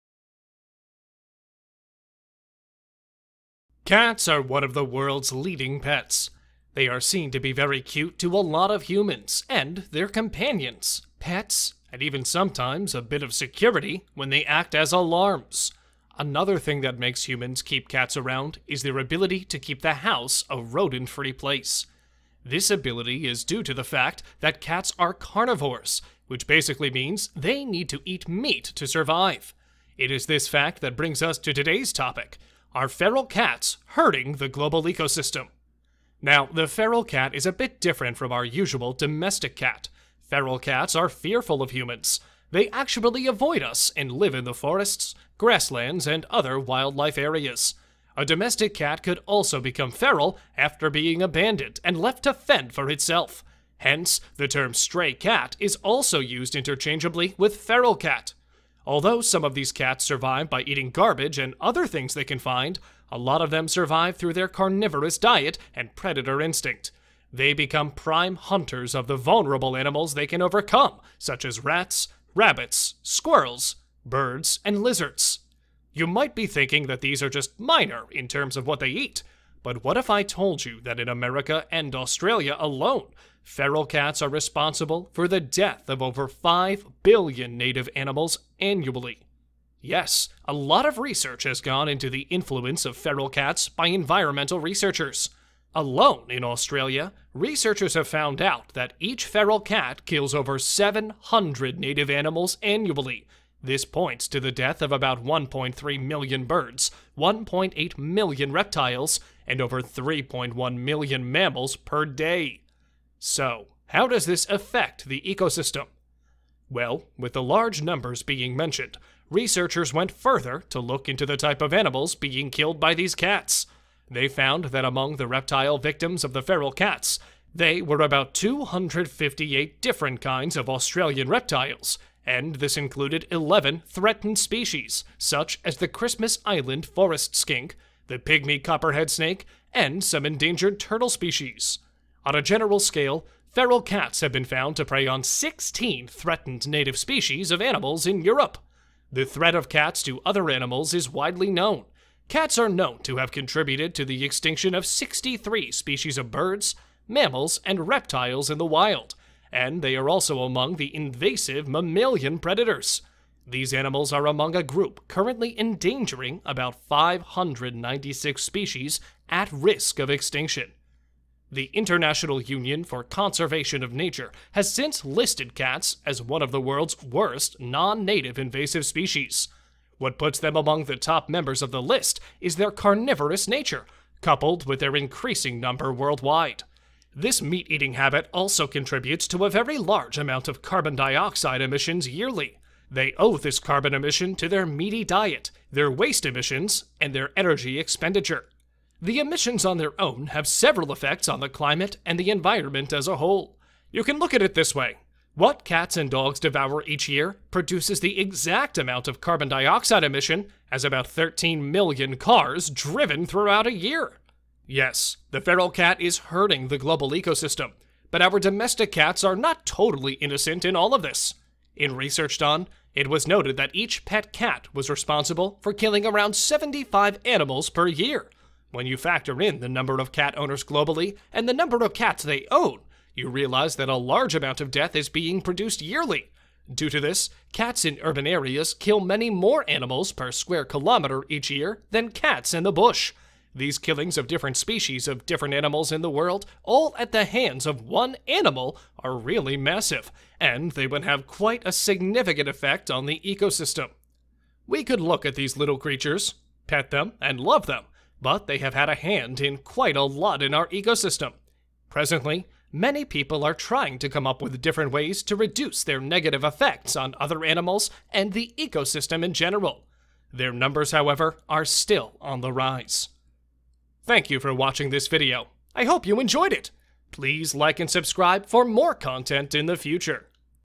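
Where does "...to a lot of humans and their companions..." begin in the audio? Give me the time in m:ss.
0:08.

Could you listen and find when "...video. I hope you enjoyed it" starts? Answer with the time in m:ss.
4:35.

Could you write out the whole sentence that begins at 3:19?
The emissions on their own have several effects on the climate and the environment as a whole.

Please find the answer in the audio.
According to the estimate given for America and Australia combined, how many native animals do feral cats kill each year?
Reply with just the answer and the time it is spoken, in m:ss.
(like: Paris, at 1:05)
over 5 billion, at 1:26.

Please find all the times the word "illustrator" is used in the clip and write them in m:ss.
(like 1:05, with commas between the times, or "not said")
not said.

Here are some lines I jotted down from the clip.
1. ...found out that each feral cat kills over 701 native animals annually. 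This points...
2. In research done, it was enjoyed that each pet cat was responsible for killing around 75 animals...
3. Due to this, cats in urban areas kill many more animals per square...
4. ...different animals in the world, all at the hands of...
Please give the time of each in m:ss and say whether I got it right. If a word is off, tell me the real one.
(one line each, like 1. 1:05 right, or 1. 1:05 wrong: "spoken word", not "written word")
1. 1:38 wrong: "700", not "701"
2. 3:41 wrong: "noted", not "enjoyed"
3. 3:56 right
4. 4:05 right.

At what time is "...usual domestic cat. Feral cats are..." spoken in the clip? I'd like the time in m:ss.
0:38.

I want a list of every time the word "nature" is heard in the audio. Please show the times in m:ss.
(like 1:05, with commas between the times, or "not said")
2:53, 3:03.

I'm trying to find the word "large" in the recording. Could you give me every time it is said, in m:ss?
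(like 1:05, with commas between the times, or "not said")
1:57, 3:09, 3:53.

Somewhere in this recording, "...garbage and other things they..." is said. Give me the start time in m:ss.
1:00.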